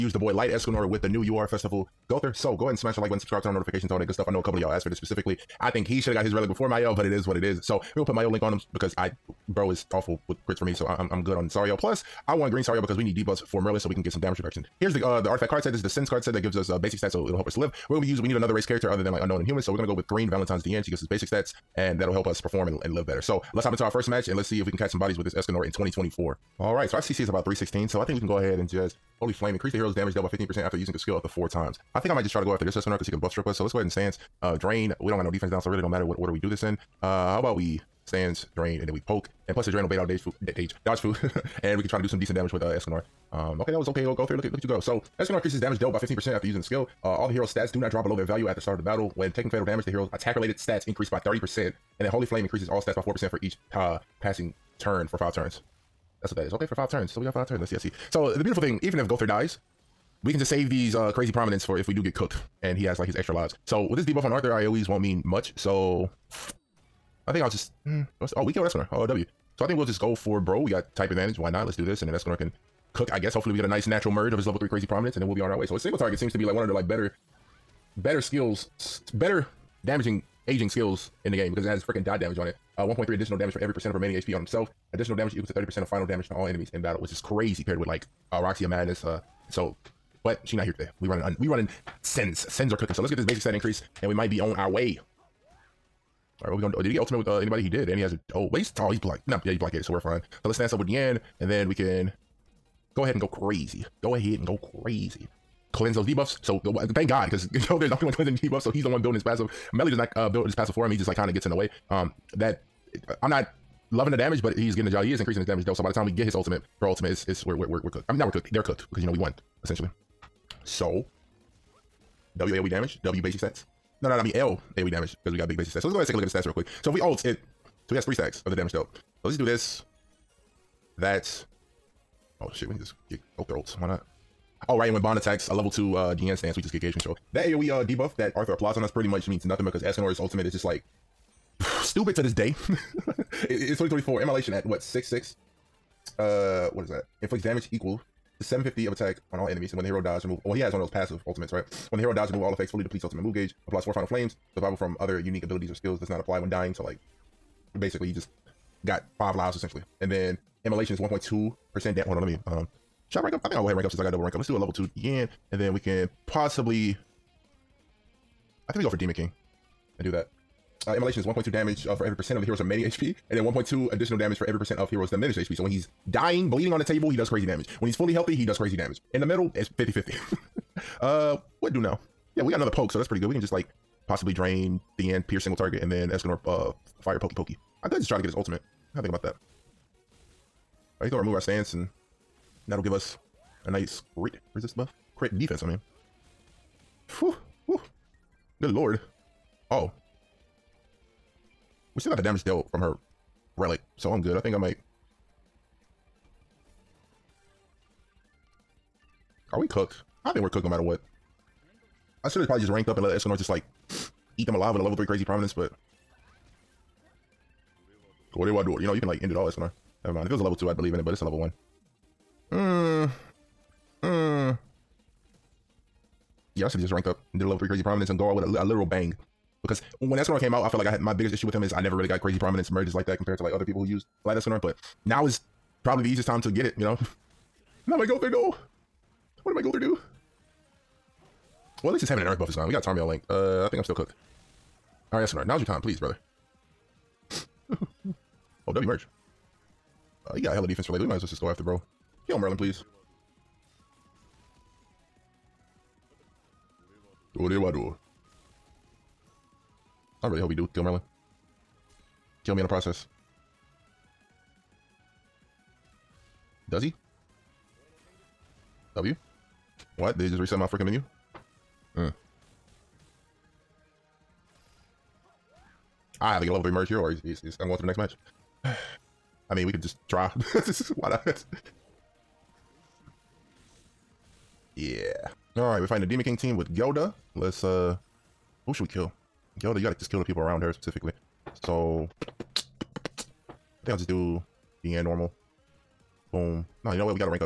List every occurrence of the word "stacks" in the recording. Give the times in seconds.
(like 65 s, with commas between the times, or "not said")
128 s.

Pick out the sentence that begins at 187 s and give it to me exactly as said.
I could just try to get his ultimate.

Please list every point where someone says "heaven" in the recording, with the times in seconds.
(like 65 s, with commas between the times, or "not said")
242 s.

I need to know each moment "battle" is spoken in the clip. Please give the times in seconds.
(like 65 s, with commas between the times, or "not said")
48 s, 86 s.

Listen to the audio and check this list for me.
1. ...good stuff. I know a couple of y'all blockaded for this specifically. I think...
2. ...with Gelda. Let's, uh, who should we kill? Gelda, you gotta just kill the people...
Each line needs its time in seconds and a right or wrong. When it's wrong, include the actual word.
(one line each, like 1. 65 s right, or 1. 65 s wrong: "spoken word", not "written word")
1. 4 s wrong: "asked", not "blockaded"
2. 286 s right.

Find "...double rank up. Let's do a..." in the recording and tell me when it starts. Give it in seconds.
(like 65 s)
164 s.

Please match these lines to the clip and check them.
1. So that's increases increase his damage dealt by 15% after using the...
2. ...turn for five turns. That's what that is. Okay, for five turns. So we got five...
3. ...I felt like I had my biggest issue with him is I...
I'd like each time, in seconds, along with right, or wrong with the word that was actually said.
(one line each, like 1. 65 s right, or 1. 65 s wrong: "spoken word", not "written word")
1. 44 s right
2. 54 s right
3. 230 s right.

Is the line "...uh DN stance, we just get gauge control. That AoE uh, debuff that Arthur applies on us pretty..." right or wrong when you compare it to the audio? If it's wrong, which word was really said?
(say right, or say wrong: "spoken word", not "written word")
right.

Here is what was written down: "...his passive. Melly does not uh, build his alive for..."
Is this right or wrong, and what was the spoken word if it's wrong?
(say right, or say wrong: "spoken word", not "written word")
wrong: "passive", not "alive".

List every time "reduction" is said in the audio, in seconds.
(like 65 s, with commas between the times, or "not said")
14 s.